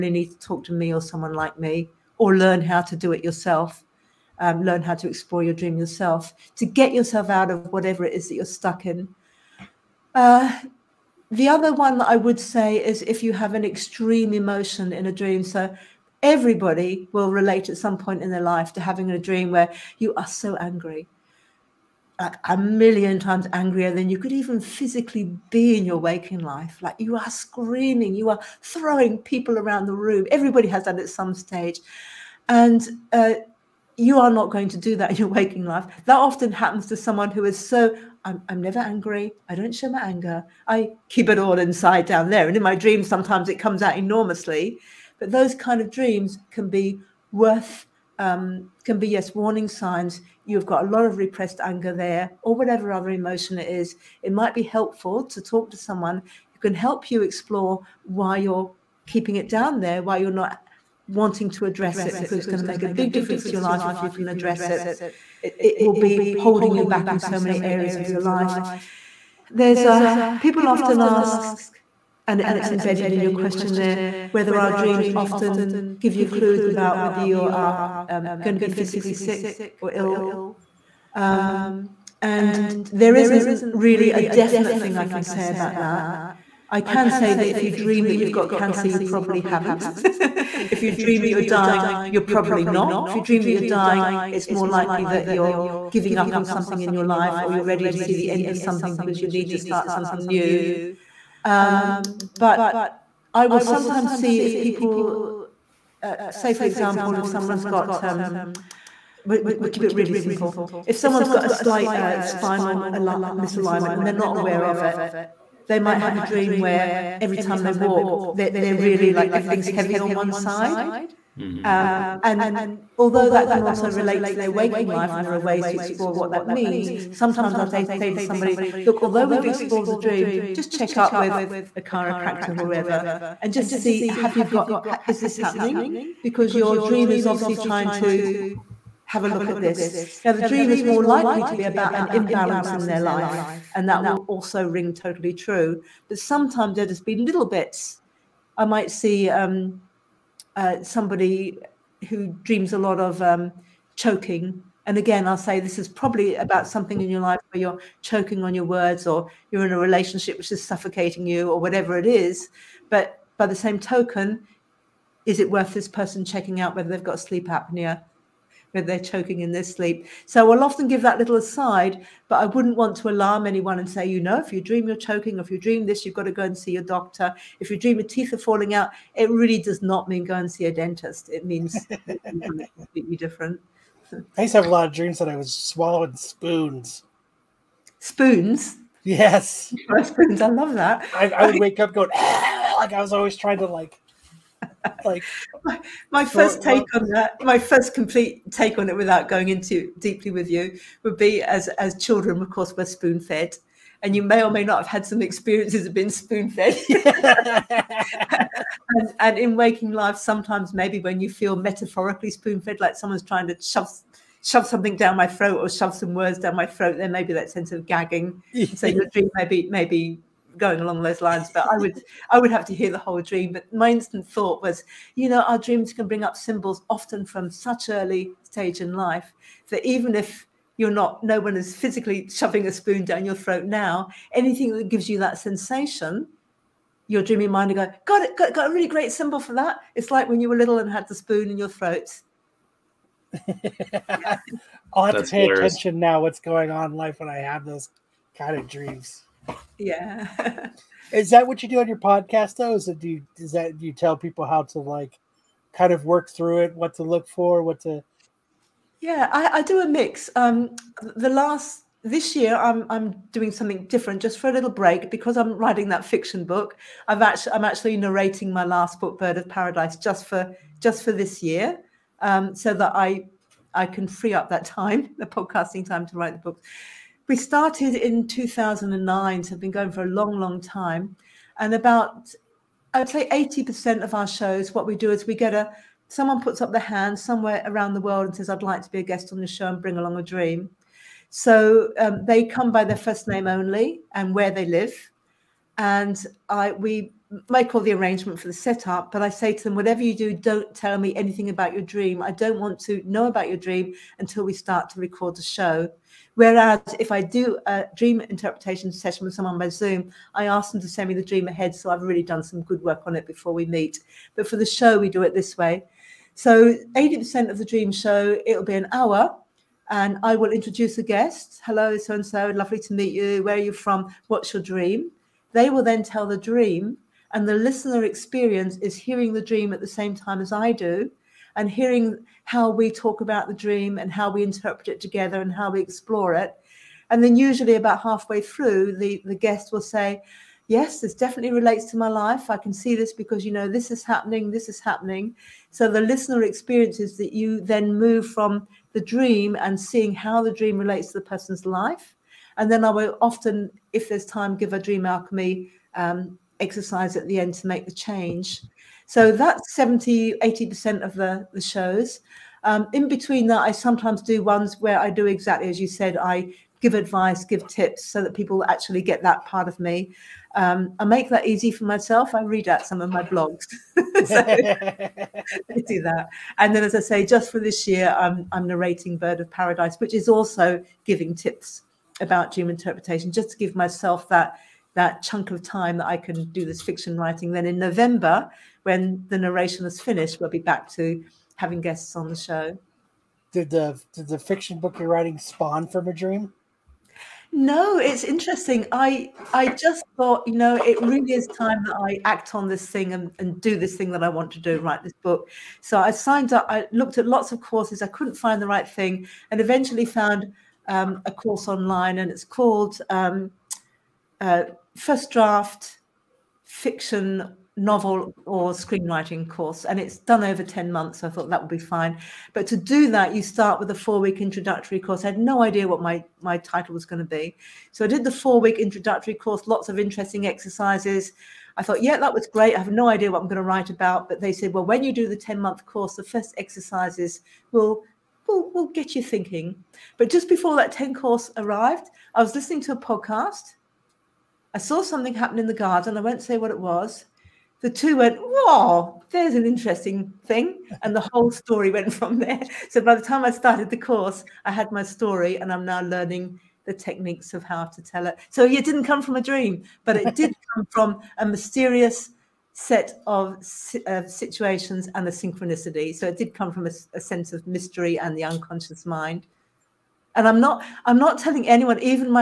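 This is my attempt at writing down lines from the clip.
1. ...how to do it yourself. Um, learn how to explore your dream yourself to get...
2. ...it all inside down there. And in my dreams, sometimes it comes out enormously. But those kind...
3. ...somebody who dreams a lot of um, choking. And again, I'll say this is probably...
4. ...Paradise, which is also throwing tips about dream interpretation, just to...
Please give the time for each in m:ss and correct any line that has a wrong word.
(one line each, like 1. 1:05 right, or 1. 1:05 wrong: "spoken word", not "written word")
1. 0:02 right
2. 0:41 right
3. 2:30 right
4. 6:19 wrong: "giving", not "throwing".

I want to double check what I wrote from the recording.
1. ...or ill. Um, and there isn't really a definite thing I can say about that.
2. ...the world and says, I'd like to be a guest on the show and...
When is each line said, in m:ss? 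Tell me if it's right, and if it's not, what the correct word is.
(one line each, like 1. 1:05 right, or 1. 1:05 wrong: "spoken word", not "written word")
1. 1:19 right
2. 4:47 right.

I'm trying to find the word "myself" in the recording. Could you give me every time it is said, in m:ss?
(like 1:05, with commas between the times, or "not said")
6:11, 6:23.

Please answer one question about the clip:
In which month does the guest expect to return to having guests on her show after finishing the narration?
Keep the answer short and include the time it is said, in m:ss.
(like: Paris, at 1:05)
November, at 6:27.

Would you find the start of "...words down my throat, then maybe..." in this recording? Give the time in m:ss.
3:36.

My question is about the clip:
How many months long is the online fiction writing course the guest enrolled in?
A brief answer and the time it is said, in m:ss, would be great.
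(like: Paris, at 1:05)
10, at 7:00.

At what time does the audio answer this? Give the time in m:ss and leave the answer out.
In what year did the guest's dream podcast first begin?
4:38.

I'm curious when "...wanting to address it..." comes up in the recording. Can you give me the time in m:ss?
1:01.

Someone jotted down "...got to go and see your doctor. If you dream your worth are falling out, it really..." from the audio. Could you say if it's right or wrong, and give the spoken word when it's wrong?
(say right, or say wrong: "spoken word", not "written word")
wrong: "teeth", not "worth".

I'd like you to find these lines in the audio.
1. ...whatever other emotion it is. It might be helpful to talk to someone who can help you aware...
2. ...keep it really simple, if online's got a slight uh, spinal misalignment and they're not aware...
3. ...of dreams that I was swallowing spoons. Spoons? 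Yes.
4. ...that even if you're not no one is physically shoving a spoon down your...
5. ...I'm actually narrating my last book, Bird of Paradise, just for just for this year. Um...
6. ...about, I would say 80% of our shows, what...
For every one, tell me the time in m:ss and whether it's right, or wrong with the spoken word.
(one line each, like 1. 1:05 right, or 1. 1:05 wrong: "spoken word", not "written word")
1. 0:52 wrong: "explore", not "aware"
2. 1:49 wrong: "someone", not "online"
3. 3:04 right
4. 3:49 right
5. 4:27 right
6. 4:41 right.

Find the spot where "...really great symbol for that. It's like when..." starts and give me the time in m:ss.
3:58.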